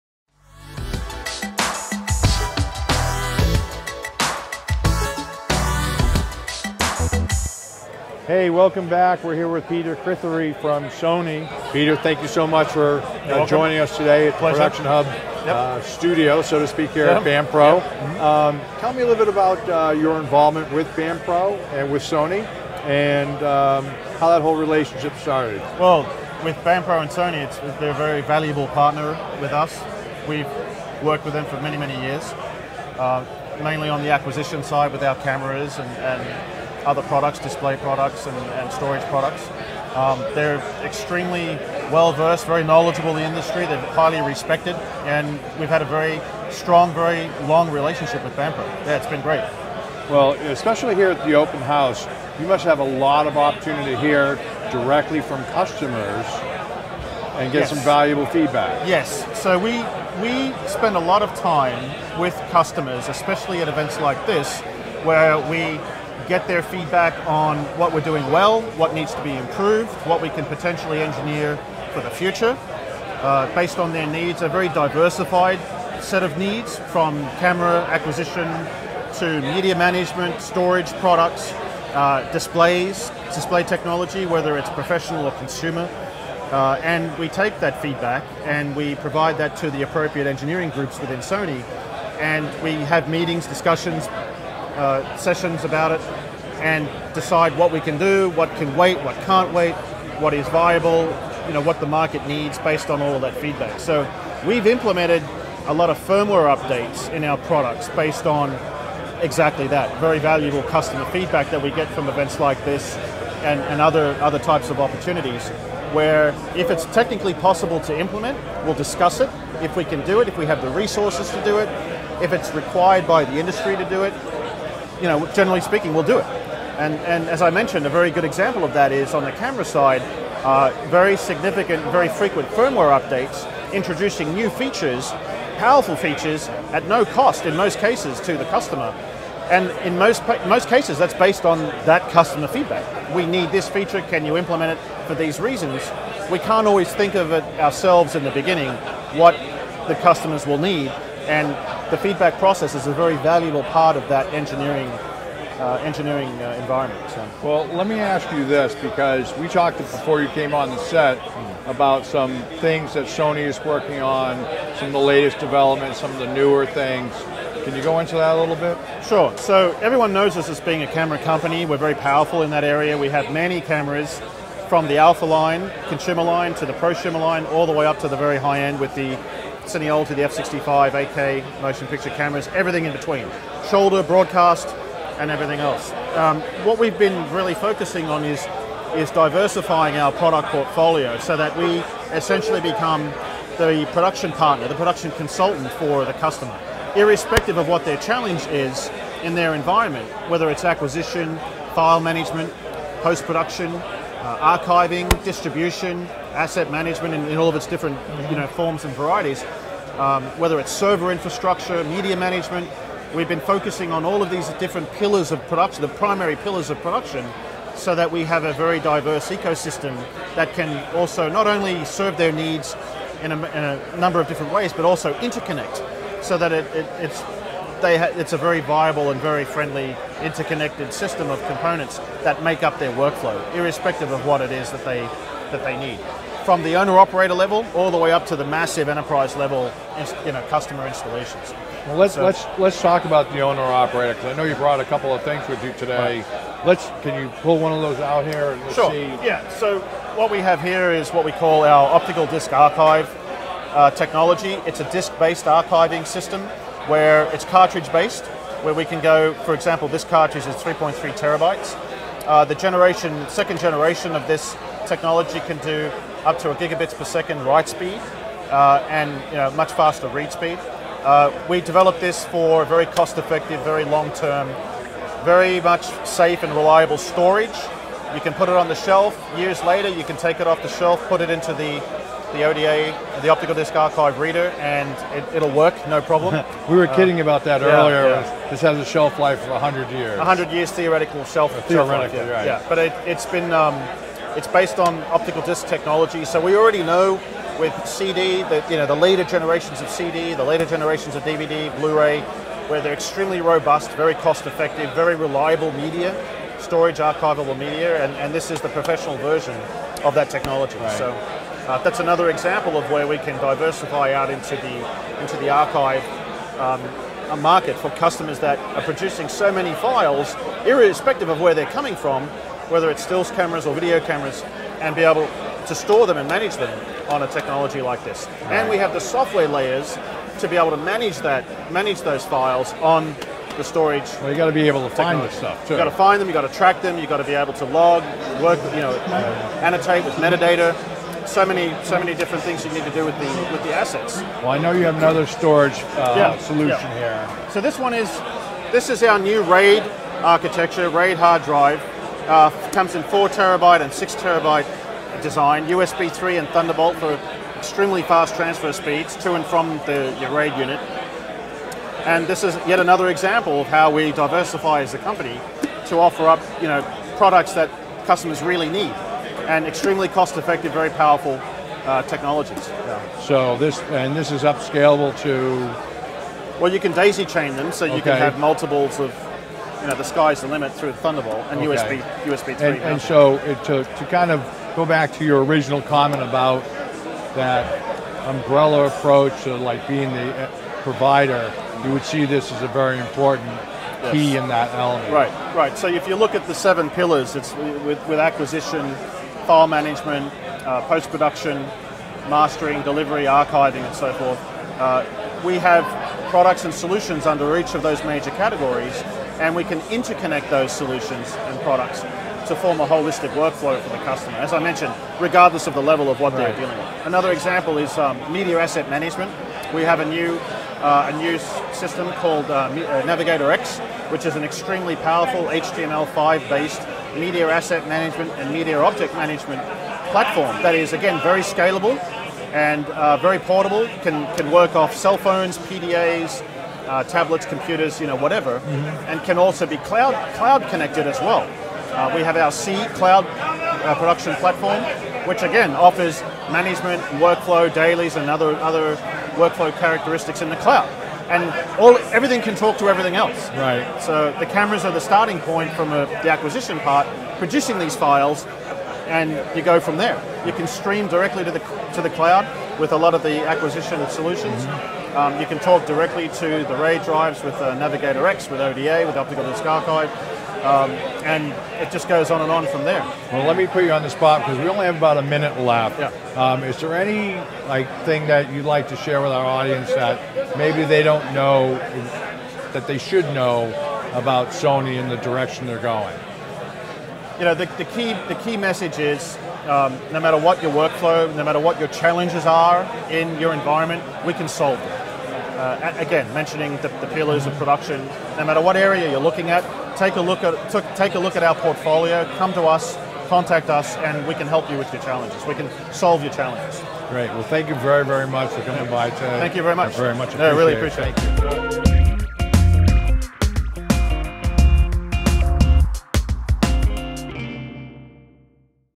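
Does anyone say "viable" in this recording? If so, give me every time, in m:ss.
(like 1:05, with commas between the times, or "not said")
1:40, 3:48.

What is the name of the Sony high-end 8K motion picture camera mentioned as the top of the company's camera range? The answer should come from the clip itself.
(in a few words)
F65.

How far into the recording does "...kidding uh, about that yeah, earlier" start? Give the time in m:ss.
4:46.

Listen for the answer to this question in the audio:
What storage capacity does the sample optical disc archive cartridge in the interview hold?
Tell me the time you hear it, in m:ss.
4:20.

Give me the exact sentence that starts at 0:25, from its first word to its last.
Well, with Band Pro and Sony, they're a very valuable partner with us.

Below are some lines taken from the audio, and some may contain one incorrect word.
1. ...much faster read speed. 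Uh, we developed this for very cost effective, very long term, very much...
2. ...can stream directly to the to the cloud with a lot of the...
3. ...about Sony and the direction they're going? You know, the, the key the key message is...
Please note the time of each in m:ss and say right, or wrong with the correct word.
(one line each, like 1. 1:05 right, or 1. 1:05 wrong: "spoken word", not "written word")
1. 4:29 right
2. 7:40 right
3. 8:04 right.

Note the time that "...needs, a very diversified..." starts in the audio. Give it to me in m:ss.
1:14.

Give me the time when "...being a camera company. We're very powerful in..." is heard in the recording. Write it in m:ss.
2:50.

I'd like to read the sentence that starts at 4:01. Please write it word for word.
Well, let's so, let's let's talk about the owner-operator because I know you brought a couple of things with you today.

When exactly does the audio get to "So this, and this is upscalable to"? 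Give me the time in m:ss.
6:13.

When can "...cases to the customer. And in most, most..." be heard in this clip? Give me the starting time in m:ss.
2:17.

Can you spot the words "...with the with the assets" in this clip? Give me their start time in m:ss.
5:43.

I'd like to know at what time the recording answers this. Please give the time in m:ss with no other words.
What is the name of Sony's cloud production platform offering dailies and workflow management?
7:22.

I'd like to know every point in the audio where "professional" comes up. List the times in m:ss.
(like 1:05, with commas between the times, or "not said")
1:24, 5:08.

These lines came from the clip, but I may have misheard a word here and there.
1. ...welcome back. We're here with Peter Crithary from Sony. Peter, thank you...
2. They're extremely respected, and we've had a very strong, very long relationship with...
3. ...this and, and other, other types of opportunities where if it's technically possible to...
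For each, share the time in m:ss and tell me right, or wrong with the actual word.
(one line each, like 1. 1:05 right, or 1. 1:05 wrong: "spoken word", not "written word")
1. 0:08 right
2. 0:43 wrong: "highly", not "extremely"
3. 1:52 right.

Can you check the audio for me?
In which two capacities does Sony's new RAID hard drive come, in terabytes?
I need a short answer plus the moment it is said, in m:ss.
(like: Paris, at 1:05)
4 and 6 terabytes, at 5:53.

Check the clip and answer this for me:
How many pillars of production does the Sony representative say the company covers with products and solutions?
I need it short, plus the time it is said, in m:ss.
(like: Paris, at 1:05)
seven, at 6:36.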